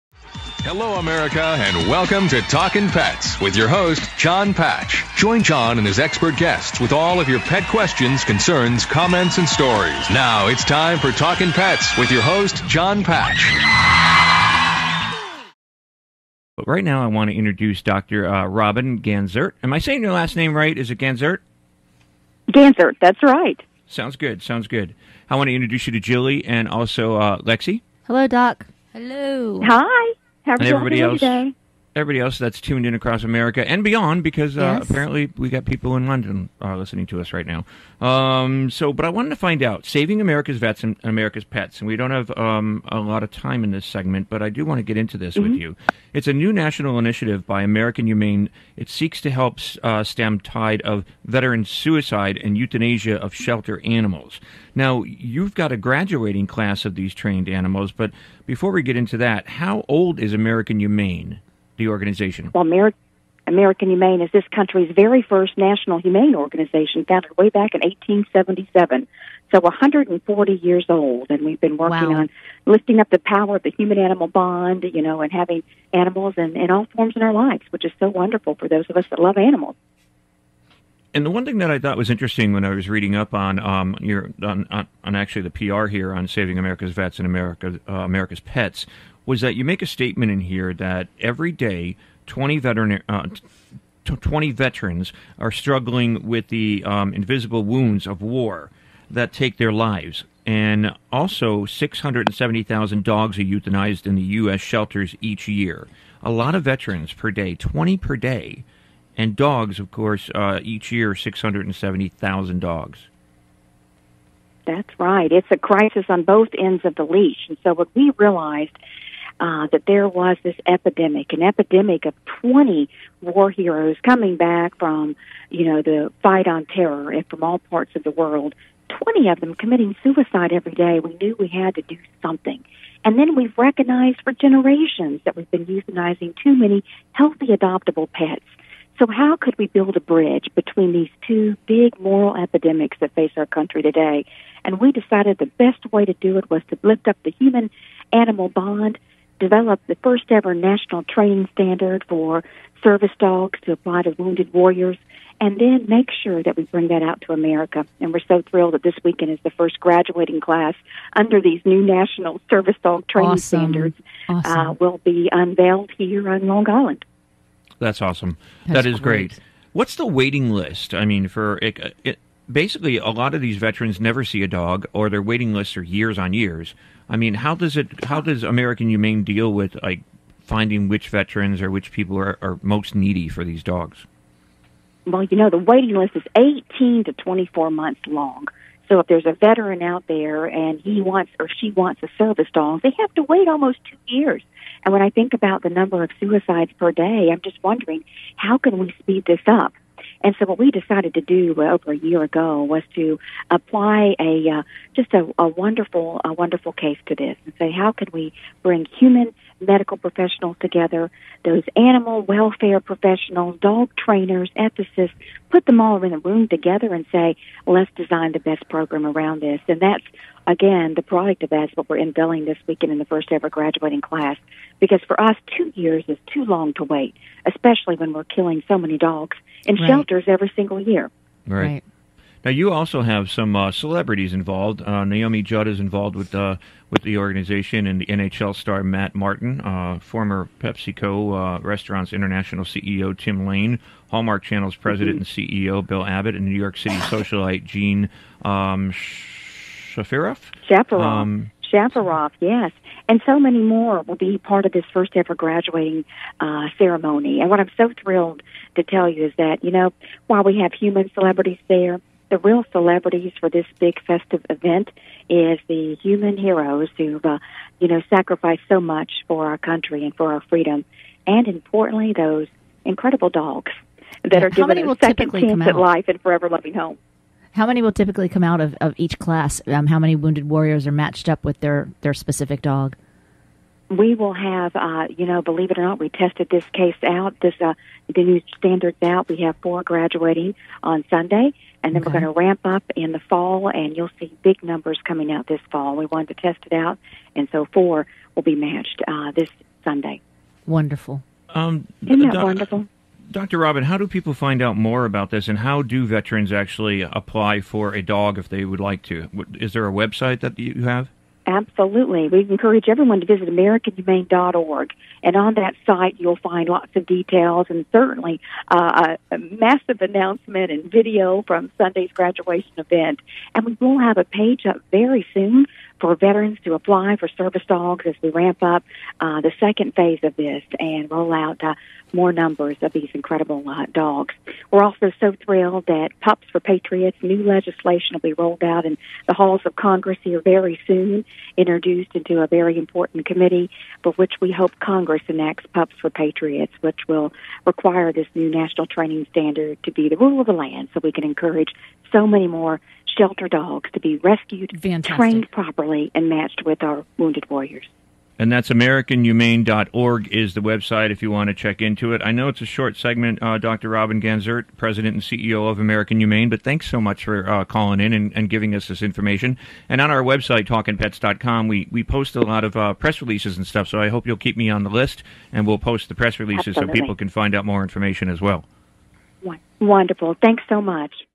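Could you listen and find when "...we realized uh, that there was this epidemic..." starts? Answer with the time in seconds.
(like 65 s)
117 s.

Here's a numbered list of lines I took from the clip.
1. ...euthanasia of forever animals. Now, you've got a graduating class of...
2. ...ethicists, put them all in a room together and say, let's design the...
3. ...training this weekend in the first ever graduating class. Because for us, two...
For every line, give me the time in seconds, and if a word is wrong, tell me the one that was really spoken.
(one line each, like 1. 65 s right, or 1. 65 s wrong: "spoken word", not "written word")
1. 52 s wrong: "shelter", not "forever"
2. 214 s right
3. 221 s wrong: "unveiling", not "training".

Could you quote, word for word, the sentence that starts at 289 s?
We have four graduating on Sunday, and then okay.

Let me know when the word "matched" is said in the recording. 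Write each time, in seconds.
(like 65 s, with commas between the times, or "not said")
280 s, 298 s, 356 s.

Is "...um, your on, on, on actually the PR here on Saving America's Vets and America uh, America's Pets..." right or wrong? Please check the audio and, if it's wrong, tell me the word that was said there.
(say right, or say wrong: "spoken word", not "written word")
right.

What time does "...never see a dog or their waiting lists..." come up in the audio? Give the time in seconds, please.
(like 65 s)
173 s.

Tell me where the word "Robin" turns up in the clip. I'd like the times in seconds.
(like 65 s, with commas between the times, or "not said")
18 s, 303 s, 363 s.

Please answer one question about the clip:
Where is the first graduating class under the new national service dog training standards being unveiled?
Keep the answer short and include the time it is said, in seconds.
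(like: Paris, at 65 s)
Long Island, at 166 s.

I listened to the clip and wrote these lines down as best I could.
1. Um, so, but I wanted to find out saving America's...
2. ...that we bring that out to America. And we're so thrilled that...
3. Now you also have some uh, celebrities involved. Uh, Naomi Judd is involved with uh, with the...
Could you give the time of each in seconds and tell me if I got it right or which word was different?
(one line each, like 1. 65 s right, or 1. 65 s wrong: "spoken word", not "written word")
1. 38 s right
2. 156 s right
3. 232 s right.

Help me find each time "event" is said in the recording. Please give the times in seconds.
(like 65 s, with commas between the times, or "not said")
264 s, 322 s.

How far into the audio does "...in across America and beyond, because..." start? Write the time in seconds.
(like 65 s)
32 s.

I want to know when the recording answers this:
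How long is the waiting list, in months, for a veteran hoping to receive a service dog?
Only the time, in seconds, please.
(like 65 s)
186 s.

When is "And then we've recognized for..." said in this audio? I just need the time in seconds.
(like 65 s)
133 s.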